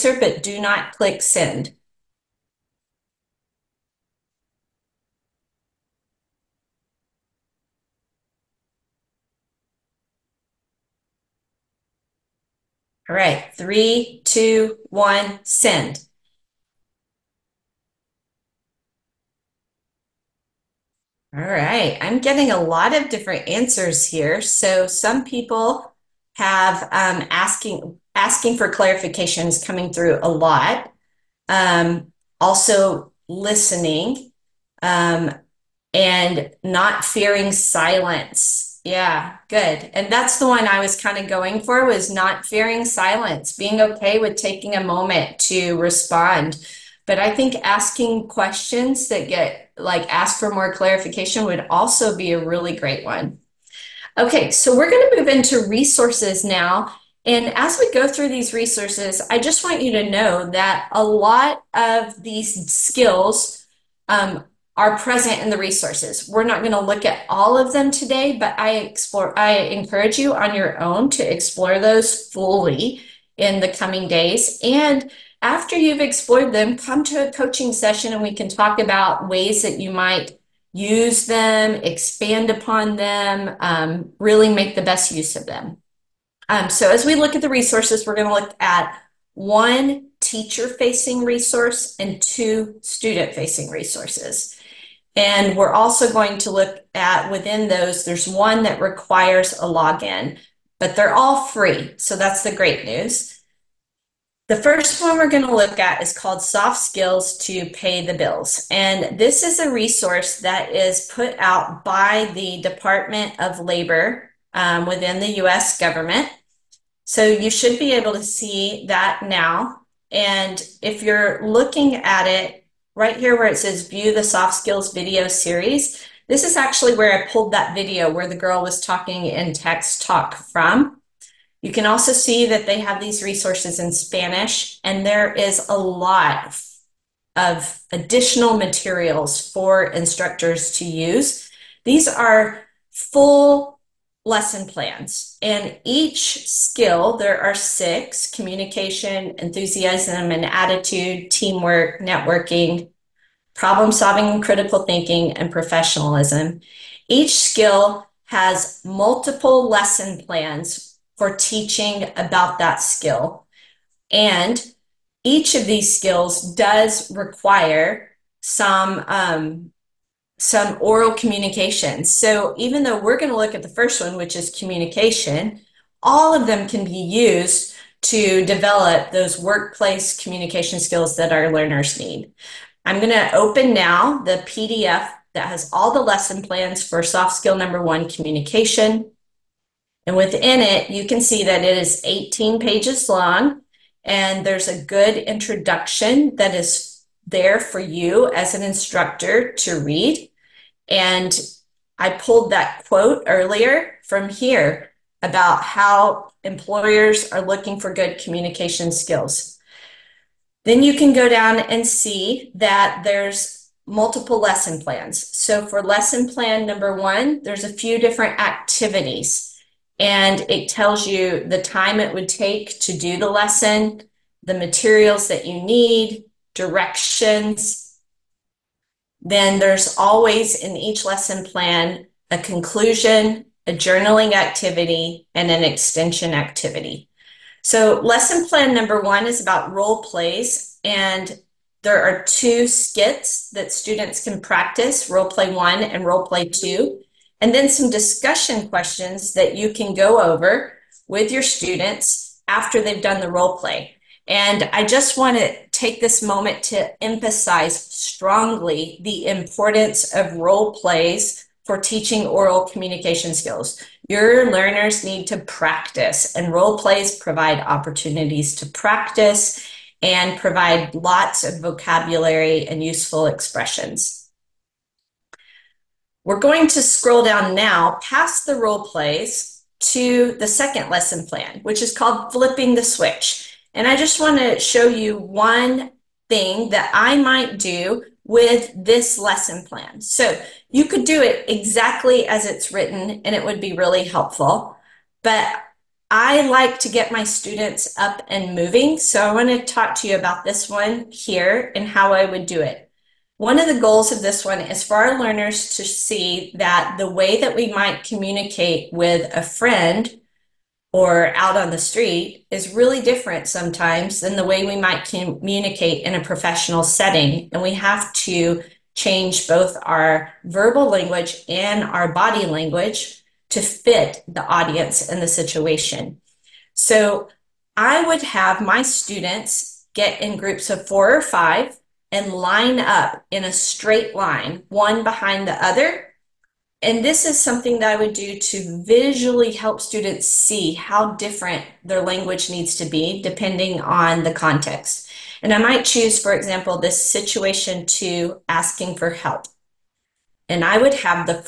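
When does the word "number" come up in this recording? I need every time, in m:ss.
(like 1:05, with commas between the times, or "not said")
3:07, 3:36, 3:58.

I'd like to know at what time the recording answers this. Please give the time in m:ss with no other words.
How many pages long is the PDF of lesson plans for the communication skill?
3:12.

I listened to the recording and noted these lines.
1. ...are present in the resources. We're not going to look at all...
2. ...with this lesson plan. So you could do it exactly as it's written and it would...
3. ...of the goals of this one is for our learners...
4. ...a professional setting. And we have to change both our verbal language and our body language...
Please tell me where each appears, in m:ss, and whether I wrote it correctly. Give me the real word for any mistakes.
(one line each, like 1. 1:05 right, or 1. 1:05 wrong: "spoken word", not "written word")
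1. 1:04 right
2. 4:48 right
3. 5:03 right
4. 5:16 right.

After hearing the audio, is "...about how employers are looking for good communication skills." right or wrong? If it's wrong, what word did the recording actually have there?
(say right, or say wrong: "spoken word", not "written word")
right.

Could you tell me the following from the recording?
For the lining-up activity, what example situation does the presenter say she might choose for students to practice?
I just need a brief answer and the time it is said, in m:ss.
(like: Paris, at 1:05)
asking for help, at 5:48.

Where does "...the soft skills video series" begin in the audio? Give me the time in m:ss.
2:04.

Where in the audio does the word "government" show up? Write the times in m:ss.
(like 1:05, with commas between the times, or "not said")
1:55.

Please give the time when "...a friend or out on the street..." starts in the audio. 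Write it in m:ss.
5:09.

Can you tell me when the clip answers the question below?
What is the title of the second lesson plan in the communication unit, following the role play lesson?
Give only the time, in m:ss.
4:42.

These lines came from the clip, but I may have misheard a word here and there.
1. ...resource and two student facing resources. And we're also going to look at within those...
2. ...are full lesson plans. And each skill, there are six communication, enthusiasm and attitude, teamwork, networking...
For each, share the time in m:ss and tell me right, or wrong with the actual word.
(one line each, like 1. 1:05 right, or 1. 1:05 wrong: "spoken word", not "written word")
1. 1:31 right
2. 2:22 right.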